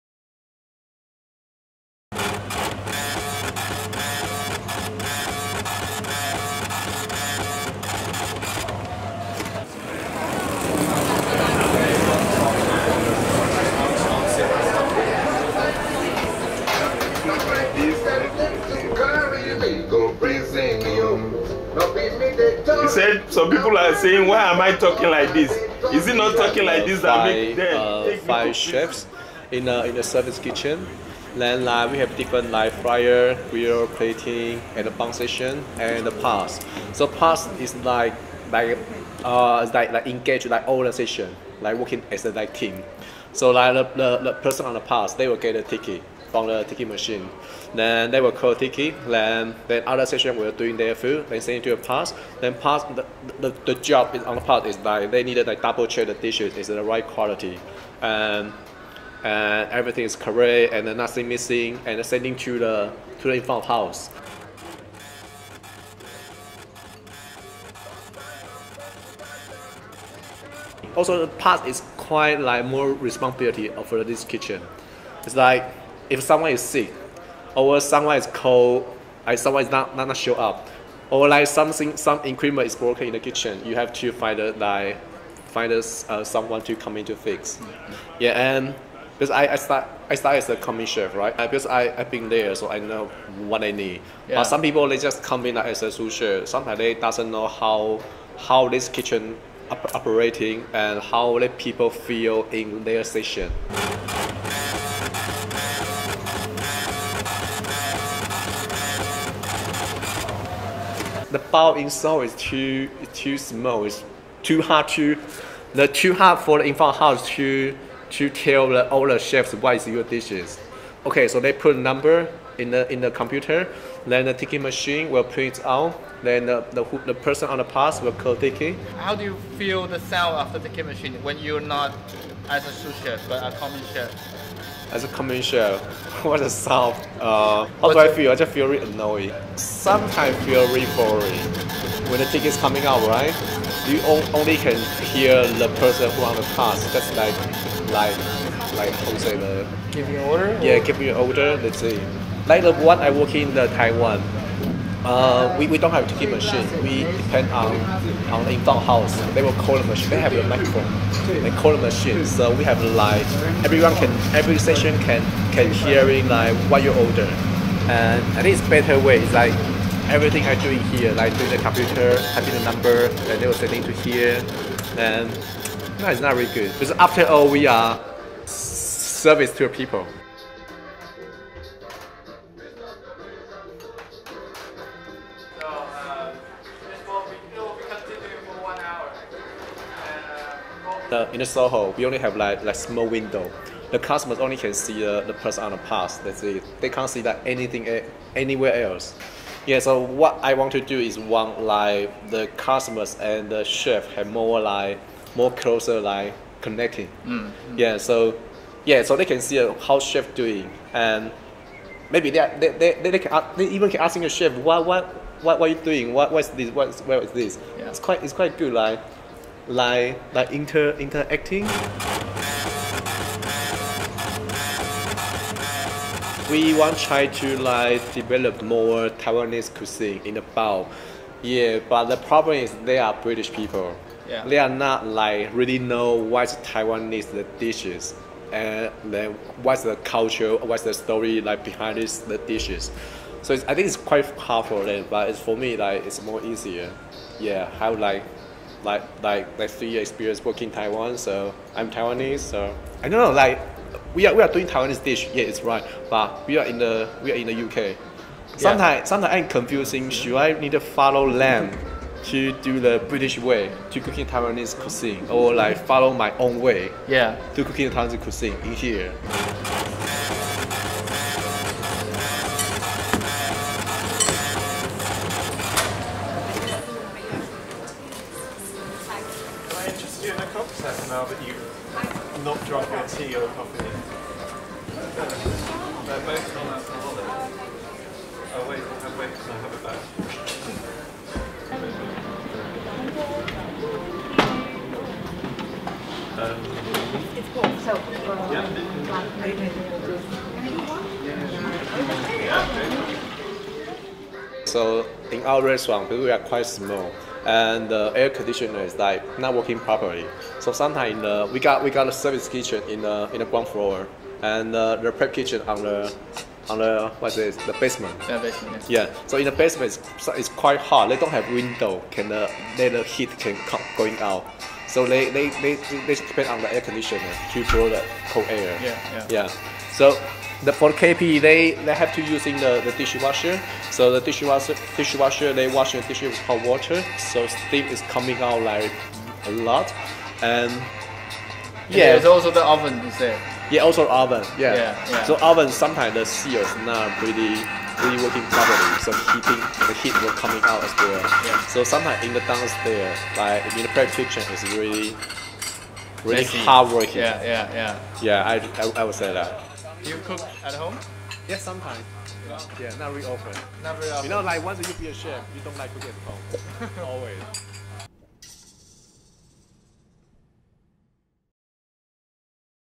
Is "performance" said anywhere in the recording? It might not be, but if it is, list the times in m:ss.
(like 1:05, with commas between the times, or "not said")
not said.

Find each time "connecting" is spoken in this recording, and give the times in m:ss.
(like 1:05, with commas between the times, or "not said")
3:26.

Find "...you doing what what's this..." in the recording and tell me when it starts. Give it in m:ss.
3:35.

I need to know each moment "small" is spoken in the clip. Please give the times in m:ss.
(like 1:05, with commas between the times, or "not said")
1:53, 3:12.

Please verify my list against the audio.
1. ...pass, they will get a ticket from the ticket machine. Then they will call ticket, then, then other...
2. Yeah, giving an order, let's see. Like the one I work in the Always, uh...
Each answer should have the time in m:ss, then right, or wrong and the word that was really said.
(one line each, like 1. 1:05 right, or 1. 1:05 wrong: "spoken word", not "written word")
1. 0:44 right
2. 2:30 wrong: "Taiwan", not "Always".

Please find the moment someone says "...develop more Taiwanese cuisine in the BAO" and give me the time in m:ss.
3:48.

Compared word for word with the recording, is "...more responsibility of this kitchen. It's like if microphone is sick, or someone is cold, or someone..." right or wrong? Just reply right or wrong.
wrong.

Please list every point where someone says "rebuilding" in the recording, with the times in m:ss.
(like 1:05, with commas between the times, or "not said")
not said.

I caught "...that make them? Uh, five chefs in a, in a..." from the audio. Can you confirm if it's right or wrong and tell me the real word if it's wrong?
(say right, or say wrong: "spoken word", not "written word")
right.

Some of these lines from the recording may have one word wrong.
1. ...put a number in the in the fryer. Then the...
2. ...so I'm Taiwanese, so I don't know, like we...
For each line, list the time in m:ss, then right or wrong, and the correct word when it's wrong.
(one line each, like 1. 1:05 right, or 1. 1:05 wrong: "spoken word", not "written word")
1. 2:01 wrong: "computer", not "fryer"
2. 4:11 right.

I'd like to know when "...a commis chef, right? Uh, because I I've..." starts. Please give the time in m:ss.
1:30.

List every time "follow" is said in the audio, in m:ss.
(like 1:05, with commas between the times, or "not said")
4:20, 4:25.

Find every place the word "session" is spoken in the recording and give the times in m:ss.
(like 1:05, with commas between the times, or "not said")
0:40, 2:44.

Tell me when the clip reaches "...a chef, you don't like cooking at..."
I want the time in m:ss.
6:05.